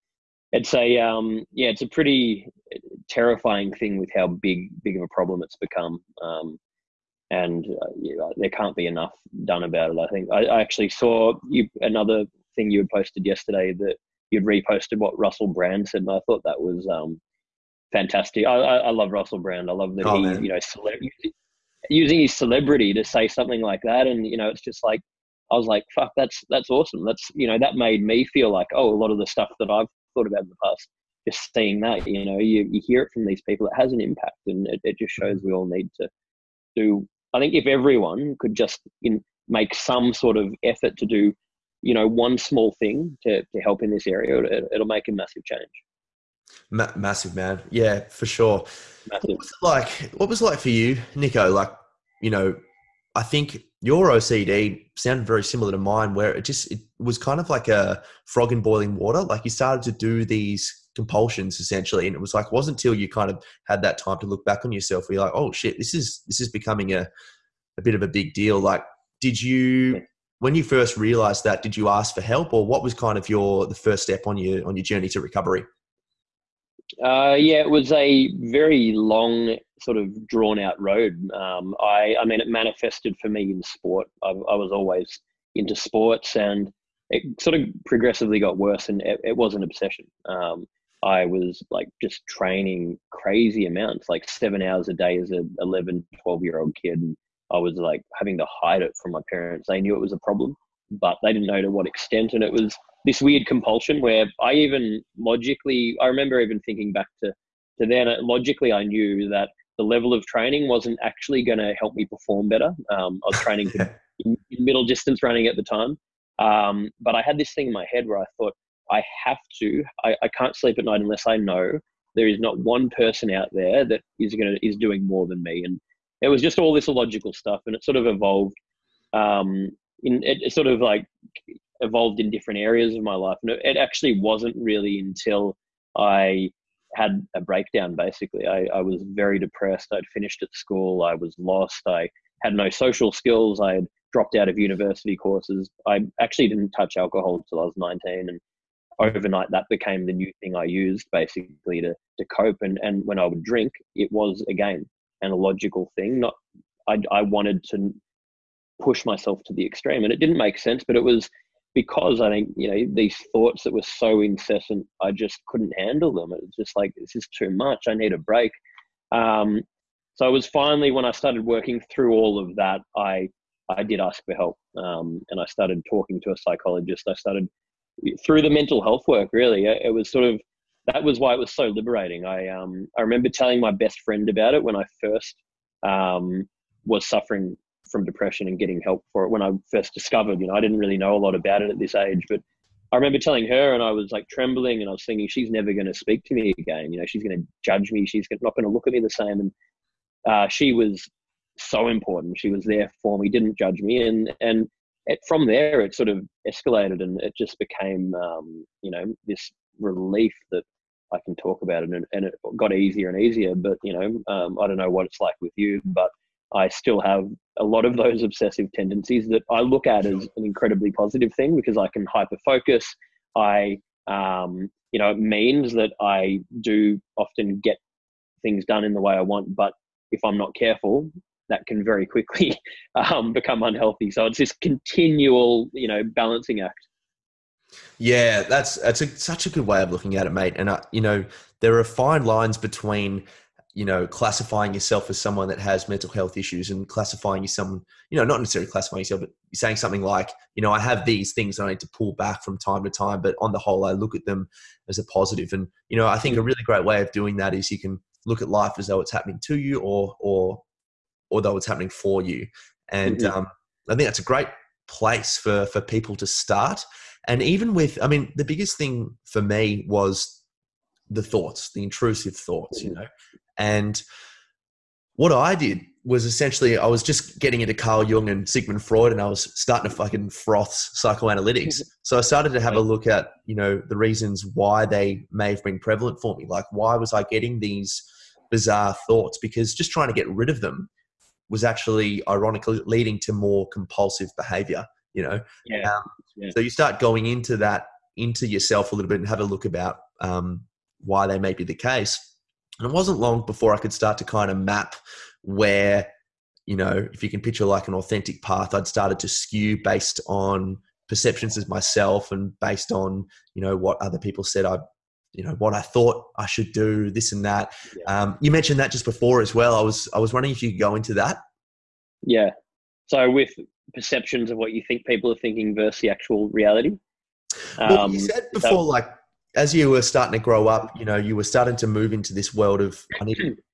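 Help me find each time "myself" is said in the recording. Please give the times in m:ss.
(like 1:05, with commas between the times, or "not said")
2:39, 5:11.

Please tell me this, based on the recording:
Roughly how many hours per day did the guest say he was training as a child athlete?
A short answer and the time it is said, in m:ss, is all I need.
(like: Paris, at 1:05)
7, at 1:34.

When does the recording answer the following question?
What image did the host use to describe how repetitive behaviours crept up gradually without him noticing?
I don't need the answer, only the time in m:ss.
0:58.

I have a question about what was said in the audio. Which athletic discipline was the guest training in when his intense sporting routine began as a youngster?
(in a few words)
middle distance running.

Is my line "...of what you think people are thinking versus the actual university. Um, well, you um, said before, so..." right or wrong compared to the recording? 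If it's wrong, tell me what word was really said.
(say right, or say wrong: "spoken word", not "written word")
wrong: "reality", not "university".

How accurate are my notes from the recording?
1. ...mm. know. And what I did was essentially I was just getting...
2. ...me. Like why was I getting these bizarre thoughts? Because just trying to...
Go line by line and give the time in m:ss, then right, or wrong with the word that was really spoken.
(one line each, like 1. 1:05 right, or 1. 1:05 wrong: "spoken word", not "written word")
1. 4:32 right
2. 4:46 right.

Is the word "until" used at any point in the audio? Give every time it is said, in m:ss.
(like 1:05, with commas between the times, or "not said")
1:02, 2:14, 2:27.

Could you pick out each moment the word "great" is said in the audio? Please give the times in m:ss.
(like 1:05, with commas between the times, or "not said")
4:16, 4:24.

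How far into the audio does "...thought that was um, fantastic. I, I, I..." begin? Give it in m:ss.
0:16.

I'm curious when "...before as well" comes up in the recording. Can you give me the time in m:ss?
5:19.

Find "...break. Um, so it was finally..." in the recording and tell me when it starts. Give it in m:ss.
2:48.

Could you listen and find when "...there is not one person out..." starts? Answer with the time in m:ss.
2:02.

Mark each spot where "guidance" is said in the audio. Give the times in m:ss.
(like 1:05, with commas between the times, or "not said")
not said.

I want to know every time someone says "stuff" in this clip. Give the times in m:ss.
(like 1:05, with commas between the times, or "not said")
0:29, 2:07.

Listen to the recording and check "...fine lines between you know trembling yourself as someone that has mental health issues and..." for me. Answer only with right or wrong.
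wrong.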